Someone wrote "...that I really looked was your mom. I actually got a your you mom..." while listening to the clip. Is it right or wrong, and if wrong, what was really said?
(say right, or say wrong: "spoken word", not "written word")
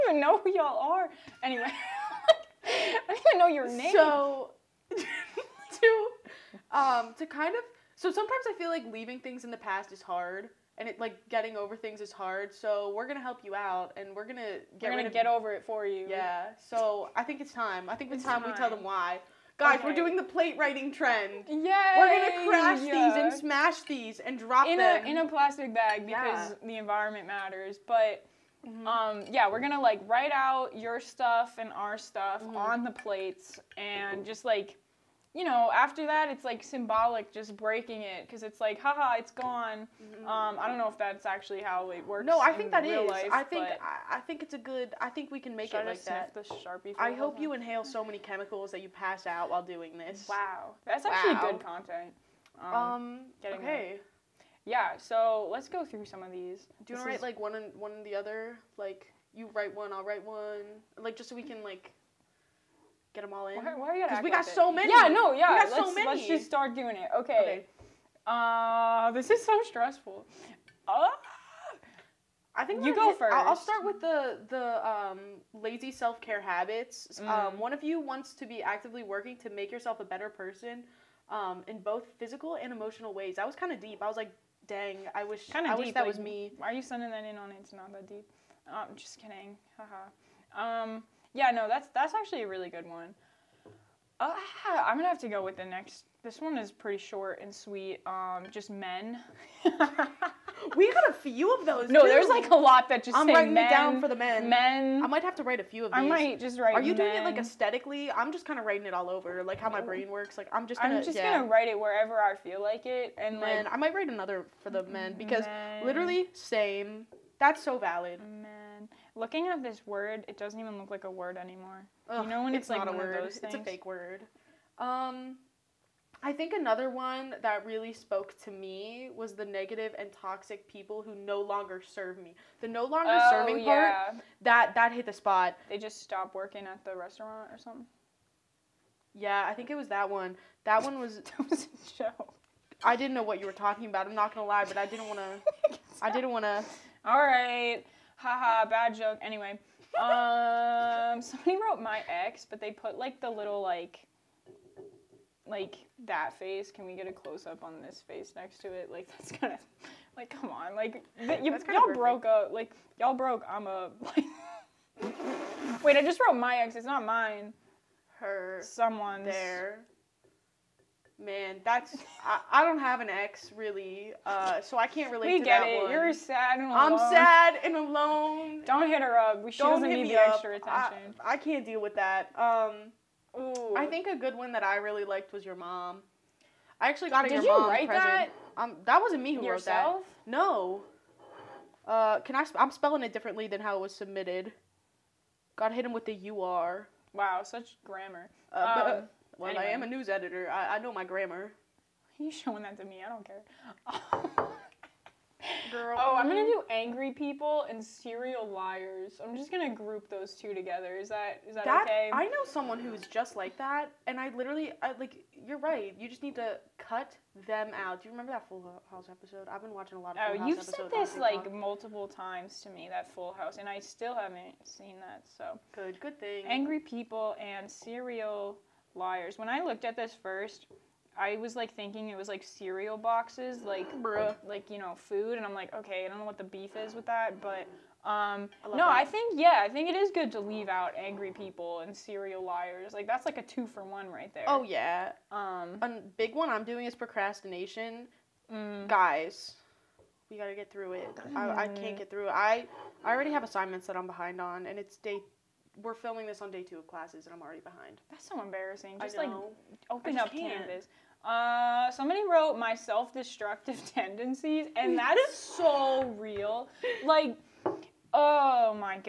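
wrong: "liked", not "looked".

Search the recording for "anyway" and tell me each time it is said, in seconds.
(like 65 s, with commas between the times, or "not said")
1 s, 149 s, 199 s.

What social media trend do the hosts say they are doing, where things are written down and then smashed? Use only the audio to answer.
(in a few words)
Plate writing trend.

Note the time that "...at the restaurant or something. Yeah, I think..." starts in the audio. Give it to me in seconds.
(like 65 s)
136 s.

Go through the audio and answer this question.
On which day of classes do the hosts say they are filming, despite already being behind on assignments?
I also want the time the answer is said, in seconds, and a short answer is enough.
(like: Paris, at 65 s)
Day two, at 256 s.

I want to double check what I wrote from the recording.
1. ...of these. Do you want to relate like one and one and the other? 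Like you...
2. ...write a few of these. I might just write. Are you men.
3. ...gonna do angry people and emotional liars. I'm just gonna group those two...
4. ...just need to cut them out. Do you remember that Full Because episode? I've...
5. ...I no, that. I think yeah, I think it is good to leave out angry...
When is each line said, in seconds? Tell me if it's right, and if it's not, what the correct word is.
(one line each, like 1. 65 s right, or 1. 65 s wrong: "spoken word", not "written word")
1. 56 s wrong: "write", not "relate"
2. 105 s right
3. 206 s wrong: "serial", not "emotional"
4. 216 s wrong: "House", not "Because"
5. 238 s right.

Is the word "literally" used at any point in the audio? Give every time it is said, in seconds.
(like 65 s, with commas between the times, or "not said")
115 s, 214 s.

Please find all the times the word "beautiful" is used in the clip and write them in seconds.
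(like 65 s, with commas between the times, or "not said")
not said.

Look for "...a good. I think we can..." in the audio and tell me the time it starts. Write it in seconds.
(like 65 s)
44 s.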